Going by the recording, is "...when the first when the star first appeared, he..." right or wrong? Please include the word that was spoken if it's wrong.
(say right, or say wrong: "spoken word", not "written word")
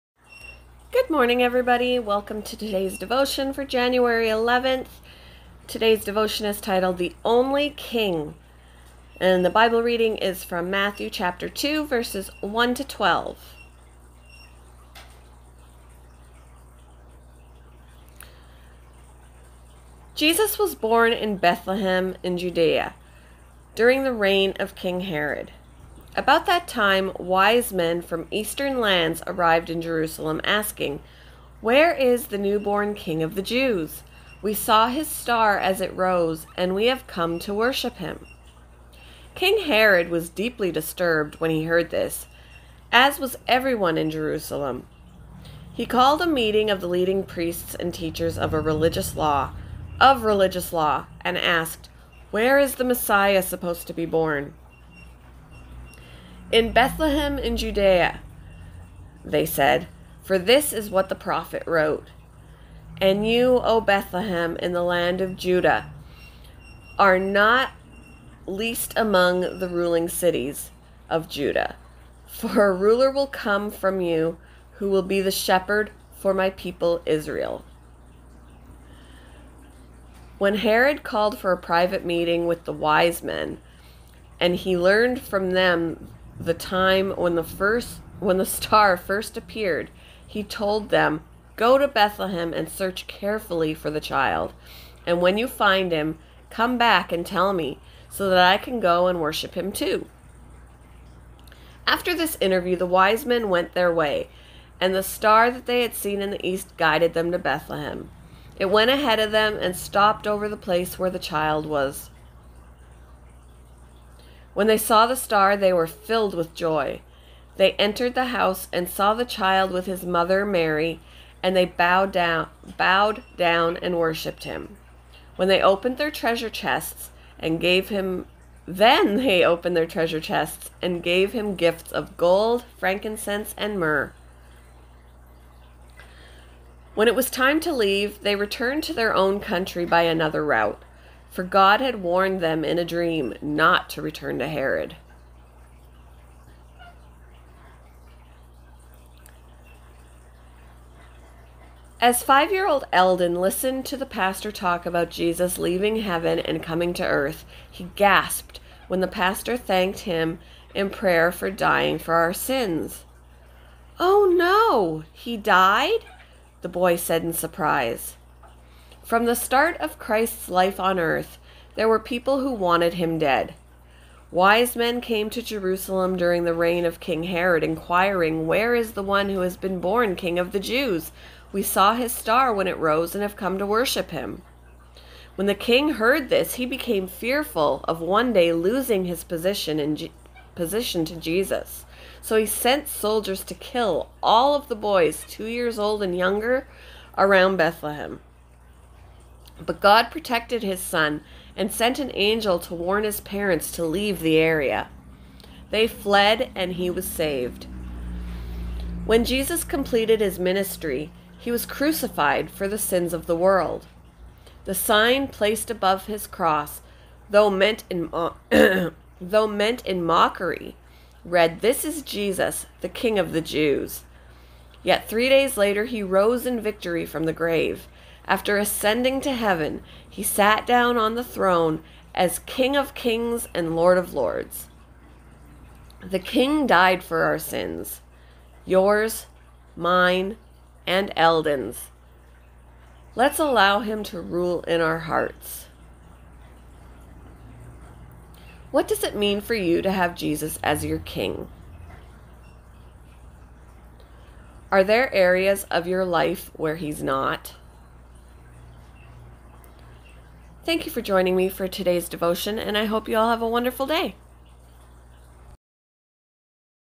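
right.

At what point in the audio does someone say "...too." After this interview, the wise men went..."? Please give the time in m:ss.
1:39.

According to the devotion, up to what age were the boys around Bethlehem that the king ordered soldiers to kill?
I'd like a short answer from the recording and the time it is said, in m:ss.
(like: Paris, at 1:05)
2 years old, at 3:15.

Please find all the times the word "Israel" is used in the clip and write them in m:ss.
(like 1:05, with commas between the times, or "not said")
1:17.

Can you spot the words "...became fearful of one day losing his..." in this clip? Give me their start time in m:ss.
3:06.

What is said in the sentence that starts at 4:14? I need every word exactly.
Are there areas of your life where he's not?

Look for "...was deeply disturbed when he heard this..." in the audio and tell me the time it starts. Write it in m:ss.
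0:40.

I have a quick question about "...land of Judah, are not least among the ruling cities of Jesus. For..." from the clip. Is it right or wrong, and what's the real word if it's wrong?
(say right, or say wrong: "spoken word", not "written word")
wrong: "Judah", not "Jesus".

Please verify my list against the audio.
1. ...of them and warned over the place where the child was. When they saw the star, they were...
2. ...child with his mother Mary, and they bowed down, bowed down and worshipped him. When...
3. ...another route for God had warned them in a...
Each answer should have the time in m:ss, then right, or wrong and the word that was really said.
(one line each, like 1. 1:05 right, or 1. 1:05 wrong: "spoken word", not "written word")
1. 1:49 wrong: "stopped", not "warned"
2. 1:59 right
3. 2:20 right.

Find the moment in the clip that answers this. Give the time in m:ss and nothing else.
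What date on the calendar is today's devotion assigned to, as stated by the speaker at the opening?
0:03.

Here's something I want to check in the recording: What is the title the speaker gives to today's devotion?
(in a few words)
The Only King.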